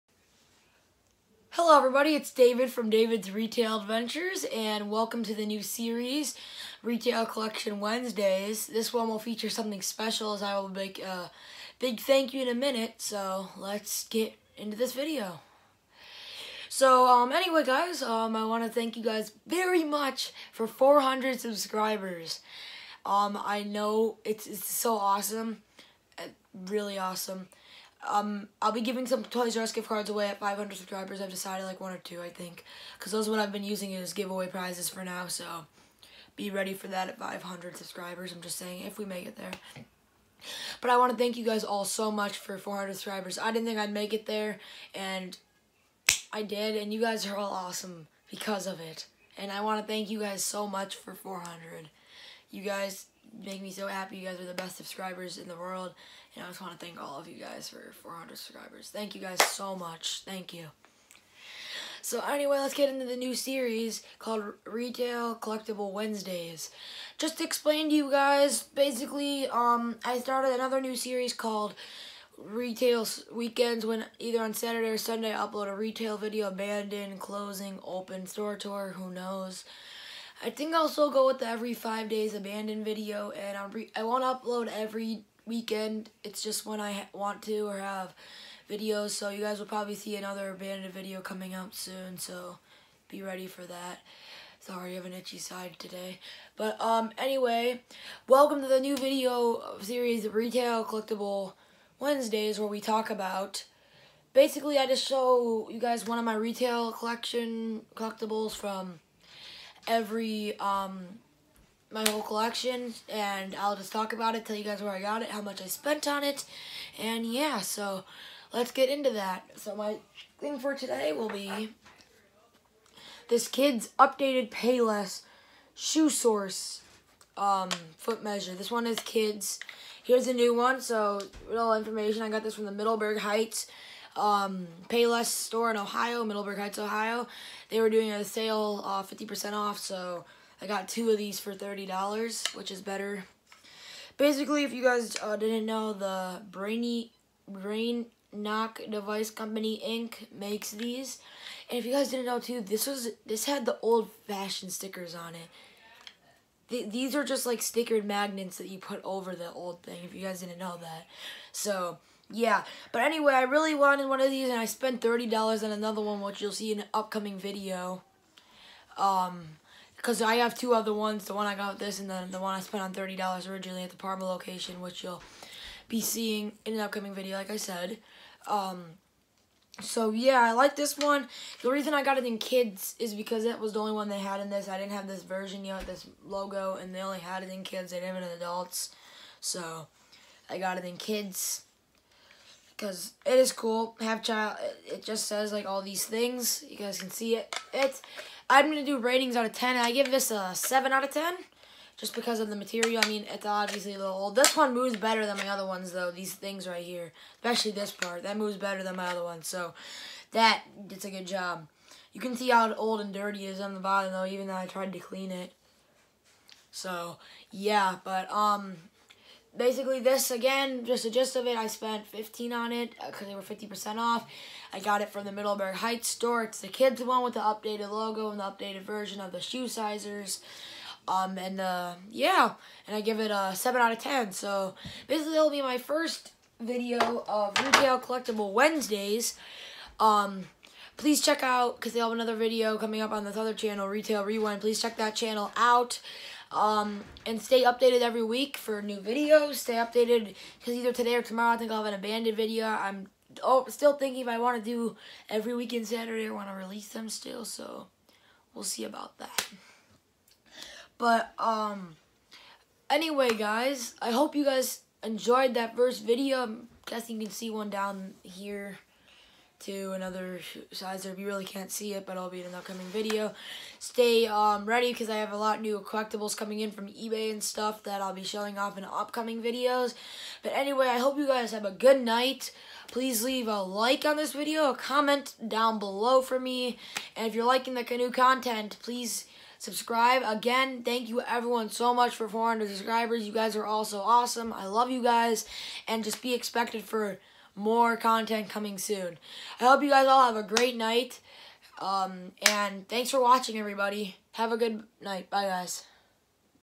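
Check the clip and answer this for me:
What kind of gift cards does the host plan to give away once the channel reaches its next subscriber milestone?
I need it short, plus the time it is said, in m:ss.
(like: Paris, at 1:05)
Toys R Us, at 0:29.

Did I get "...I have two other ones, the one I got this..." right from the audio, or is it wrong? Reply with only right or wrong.
right.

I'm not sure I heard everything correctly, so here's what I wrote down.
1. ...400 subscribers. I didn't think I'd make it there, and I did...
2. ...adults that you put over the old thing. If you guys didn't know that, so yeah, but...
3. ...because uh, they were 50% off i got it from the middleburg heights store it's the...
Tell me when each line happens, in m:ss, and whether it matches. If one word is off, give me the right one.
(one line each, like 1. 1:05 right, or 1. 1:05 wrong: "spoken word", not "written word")
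1. 0:42 right
2. 2:38 wrong: "magnets", not "adults"
3. 3:43 right.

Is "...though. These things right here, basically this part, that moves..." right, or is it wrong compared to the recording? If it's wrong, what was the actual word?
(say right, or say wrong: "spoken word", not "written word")
wrong: "especially", not "basically".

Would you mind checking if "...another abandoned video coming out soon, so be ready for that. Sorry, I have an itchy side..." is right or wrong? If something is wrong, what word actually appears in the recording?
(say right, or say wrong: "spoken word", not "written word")
right.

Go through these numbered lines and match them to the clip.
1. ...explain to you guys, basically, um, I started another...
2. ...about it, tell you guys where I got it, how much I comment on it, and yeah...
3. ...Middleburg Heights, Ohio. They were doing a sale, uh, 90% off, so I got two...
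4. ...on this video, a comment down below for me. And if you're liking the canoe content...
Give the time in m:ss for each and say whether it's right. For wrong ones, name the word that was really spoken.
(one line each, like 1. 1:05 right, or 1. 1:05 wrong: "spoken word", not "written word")
1. 1:07 right
2. 1:54 wrong: "spent", not "comment"
3. 2:16 wrong: "50", not "90"
4. 4:44 right.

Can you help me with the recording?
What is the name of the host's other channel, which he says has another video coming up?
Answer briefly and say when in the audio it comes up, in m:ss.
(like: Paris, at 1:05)
Retail Rewind, at 4:03.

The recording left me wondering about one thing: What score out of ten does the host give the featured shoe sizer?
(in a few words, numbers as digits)
7.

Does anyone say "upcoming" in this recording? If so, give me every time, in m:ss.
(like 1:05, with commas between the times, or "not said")
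2:46, 2:56, 4:32, 4:38.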